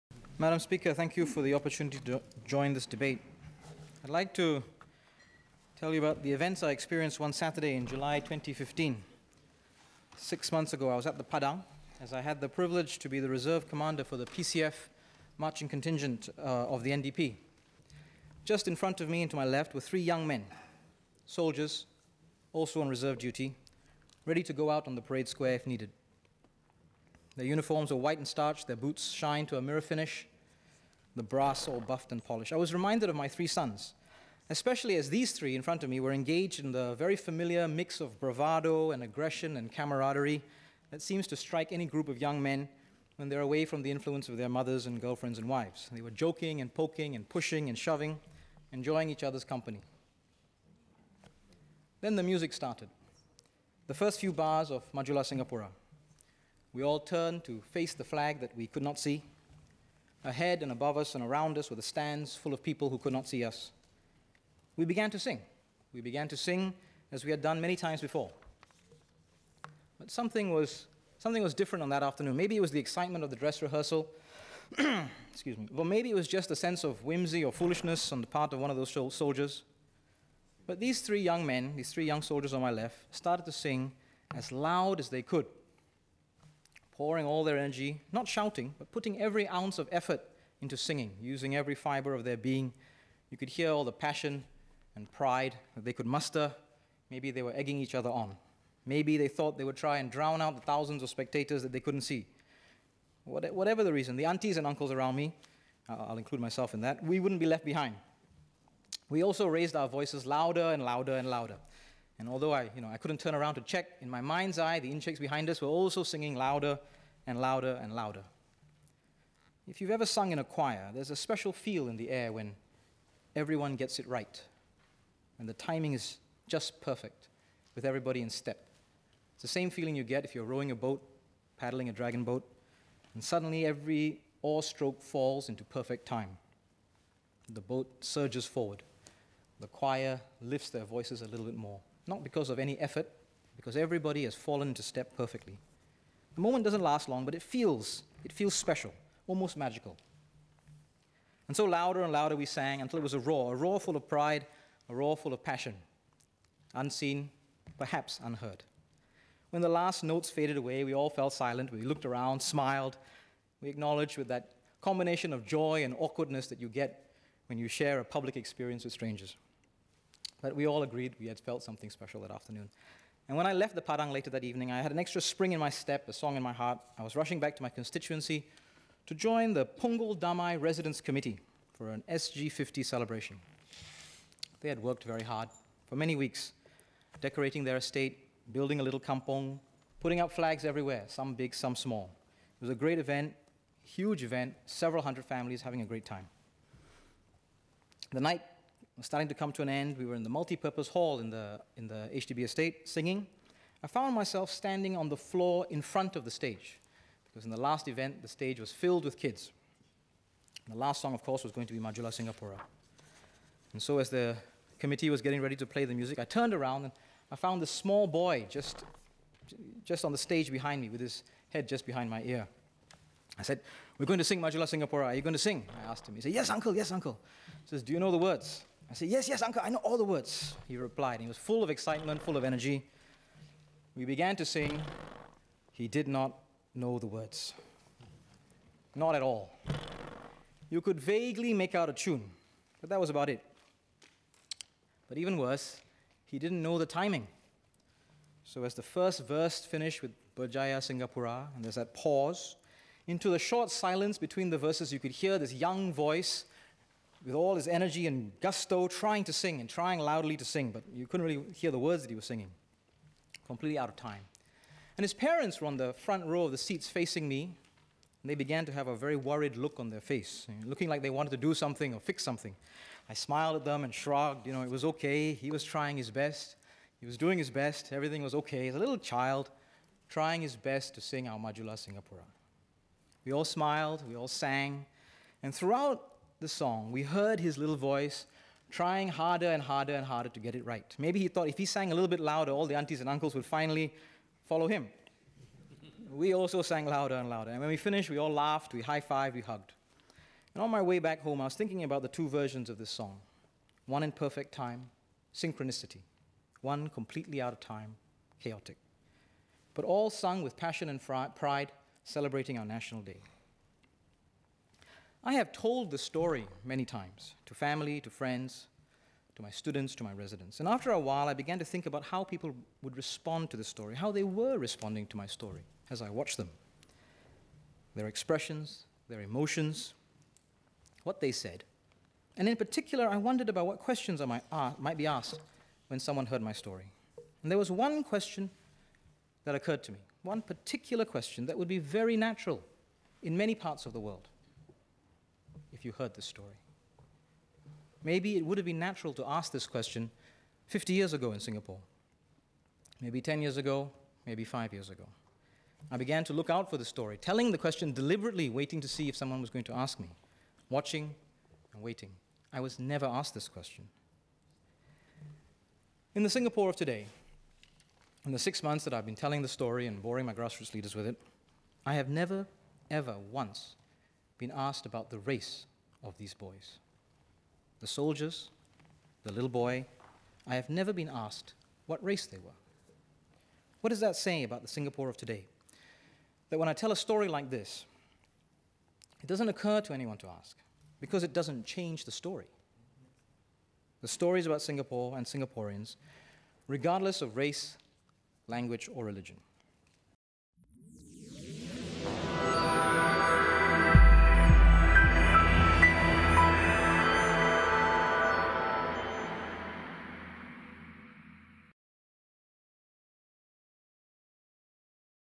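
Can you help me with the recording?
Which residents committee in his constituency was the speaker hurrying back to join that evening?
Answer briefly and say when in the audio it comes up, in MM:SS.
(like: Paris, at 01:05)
Punggol Damai Residents Committee, at 02:59.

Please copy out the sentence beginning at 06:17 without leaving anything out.
The soldiers, the little boy, I have never been asked what race they were.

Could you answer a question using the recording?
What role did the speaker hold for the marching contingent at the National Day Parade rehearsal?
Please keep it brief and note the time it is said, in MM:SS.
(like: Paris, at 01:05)
Reserve commander, at 00:13.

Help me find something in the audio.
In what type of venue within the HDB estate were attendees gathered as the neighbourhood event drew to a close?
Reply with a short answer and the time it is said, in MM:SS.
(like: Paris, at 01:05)
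Multi-purpose hall, at 03:20.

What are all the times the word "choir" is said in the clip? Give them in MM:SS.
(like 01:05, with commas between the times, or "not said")
02:00, 02:19.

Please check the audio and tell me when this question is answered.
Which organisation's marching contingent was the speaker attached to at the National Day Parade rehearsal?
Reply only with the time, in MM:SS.
00:14.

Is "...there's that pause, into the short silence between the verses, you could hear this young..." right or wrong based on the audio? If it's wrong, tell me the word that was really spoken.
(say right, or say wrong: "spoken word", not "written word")
right.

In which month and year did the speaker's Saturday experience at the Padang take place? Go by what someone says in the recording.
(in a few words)
July 2015.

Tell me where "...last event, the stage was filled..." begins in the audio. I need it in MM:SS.
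03:27.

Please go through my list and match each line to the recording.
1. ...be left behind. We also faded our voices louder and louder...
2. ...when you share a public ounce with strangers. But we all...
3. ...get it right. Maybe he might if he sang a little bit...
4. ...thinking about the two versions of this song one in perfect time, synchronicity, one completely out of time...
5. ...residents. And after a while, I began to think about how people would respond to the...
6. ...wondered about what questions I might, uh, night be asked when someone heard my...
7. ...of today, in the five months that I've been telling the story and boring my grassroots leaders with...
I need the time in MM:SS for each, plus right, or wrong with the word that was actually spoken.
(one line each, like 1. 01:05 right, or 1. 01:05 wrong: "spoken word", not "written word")
1. 01:47 wrong: "raised", not "faded"
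2. 02:47 wrong: "experience", not "ounce"
3. 04:50 wrong: "thought", not "might"
4. 05:01 right
5. 05:20 right
6. 05:33 wrong: "might", not "night"
7. 06:06 wrong: "six", not "five".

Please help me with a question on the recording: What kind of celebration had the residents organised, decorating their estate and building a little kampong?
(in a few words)
SG50 celebration.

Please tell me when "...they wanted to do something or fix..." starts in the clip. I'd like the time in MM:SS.
04:31.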